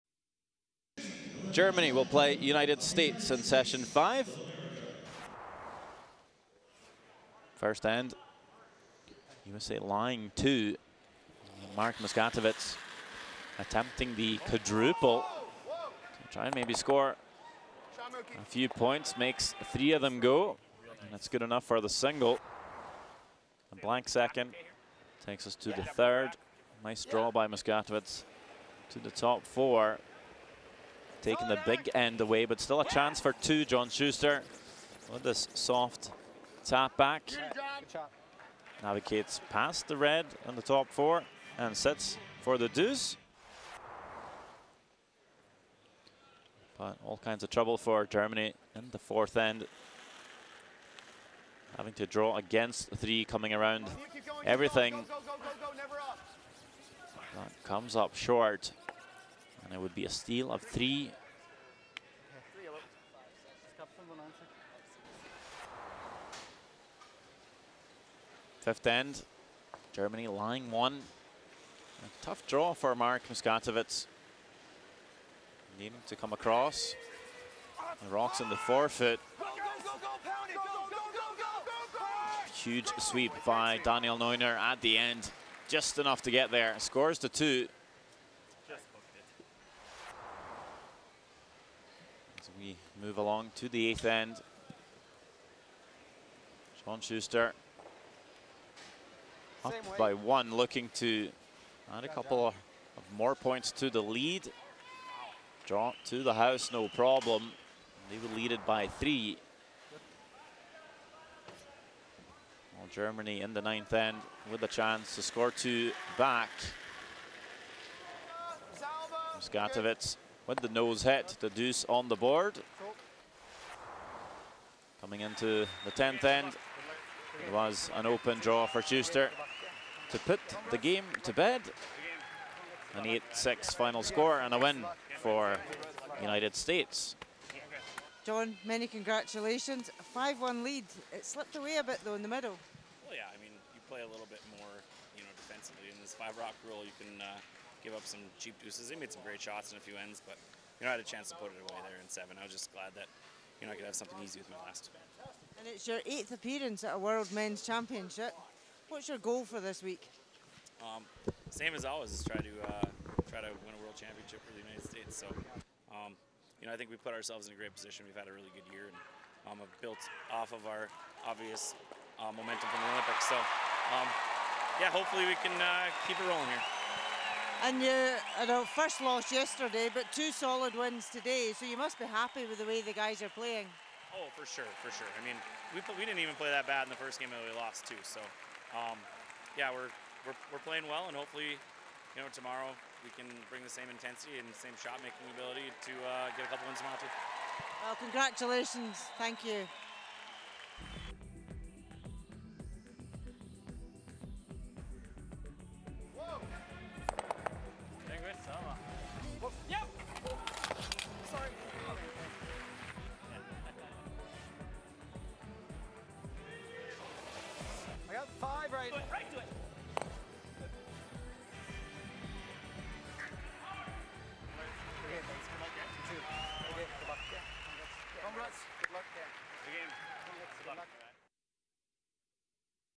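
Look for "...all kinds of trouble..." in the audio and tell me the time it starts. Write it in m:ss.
0:47.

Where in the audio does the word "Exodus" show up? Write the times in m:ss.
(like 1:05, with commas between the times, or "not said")
not said.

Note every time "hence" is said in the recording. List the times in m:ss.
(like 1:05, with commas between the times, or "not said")
not said.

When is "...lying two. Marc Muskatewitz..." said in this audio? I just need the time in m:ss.
0:09.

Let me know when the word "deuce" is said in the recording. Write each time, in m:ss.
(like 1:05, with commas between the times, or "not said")
0:42, 2:01, 2:28.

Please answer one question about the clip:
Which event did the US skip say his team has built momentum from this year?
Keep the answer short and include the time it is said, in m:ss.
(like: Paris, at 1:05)
The Olympics, at 2:52.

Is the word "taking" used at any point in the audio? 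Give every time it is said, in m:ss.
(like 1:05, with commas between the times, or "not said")
0:31.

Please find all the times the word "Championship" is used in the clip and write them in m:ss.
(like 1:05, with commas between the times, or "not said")
2:37, 2:43.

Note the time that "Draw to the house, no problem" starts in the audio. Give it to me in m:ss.
1:45.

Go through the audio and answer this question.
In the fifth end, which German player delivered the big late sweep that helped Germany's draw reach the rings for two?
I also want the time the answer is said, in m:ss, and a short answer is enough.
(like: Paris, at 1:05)
Daniel Neuner, at 1:23.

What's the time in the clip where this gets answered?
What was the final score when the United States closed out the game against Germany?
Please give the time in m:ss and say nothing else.
2:13.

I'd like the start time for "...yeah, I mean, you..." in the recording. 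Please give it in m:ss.
2:23.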